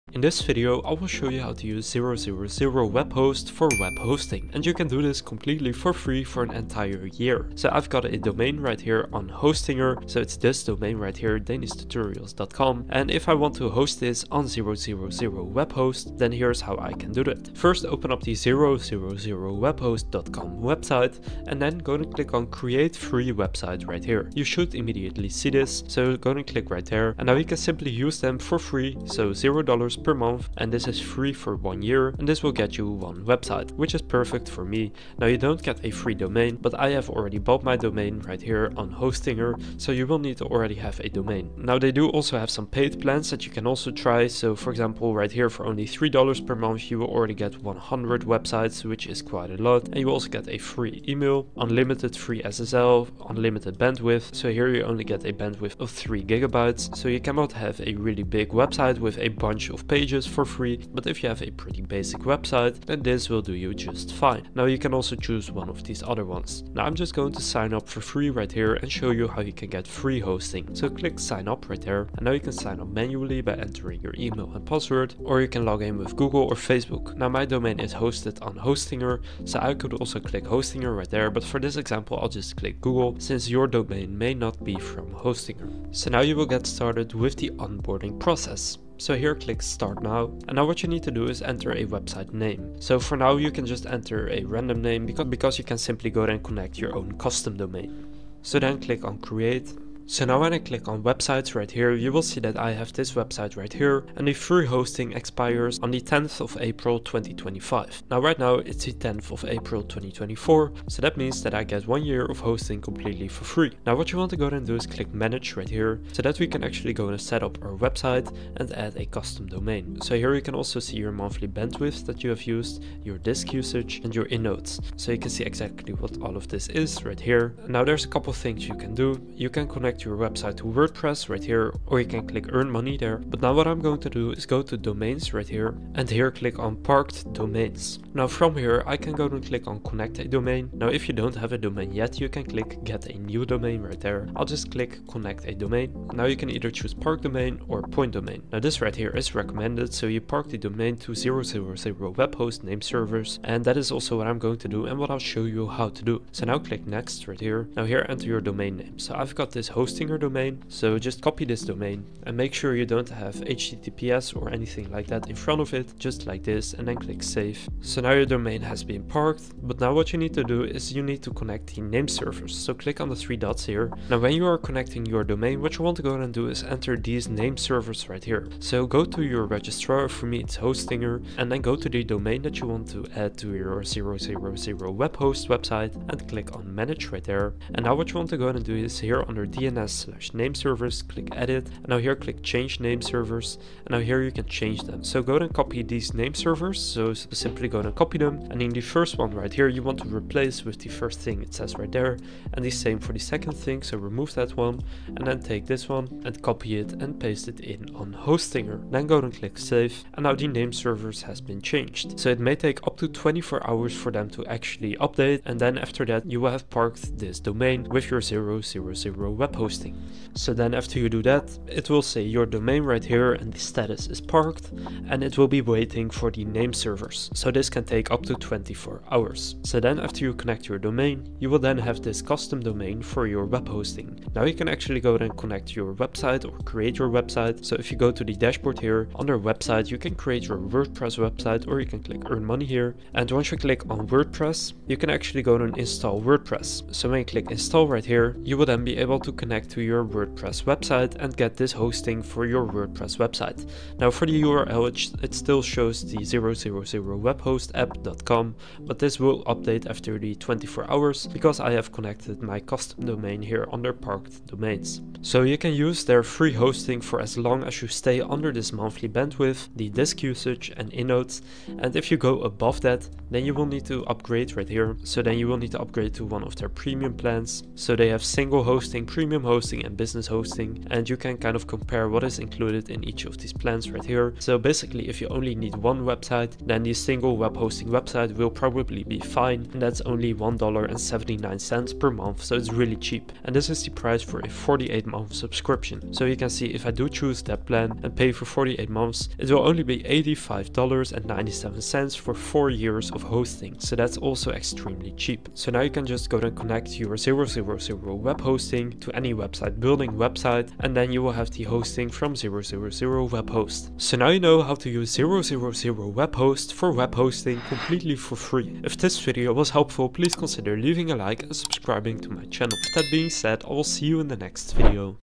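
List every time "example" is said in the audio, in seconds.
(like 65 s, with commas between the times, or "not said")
44 s, 81 s.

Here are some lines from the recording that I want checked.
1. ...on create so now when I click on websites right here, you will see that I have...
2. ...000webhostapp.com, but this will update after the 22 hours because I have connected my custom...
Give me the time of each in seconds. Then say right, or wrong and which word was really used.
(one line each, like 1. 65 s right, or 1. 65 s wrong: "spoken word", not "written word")
1. 99 s right
2. 256 s wrong: "24", not "22".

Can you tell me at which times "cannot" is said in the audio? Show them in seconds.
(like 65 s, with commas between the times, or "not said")
57 s.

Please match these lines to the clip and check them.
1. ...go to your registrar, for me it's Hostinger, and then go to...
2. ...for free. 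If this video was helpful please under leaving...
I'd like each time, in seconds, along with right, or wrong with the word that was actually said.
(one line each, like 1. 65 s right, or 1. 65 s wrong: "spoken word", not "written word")
1. 178 s right
2. 318 s wrong: "consider", not "under".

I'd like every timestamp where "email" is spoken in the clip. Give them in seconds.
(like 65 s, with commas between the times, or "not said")
51 s, 74 s.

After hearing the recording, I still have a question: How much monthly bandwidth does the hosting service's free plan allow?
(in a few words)
3 gigabytes.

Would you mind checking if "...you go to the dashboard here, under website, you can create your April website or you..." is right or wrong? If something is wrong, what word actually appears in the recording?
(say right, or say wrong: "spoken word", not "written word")
wrong: "WordPress", not "April".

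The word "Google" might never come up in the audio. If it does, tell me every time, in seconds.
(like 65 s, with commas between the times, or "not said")
76 s, 82 s.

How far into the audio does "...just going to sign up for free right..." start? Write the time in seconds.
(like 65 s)
66 s.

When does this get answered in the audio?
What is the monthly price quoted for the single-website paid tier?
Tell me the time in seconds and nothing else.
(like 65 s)
290 s.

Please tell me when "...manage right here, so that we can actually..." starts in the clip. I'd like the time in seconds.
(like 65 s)
115 s.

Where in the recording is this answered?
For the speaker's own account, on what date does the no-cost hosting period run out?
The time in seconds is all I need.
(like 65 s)
106 s.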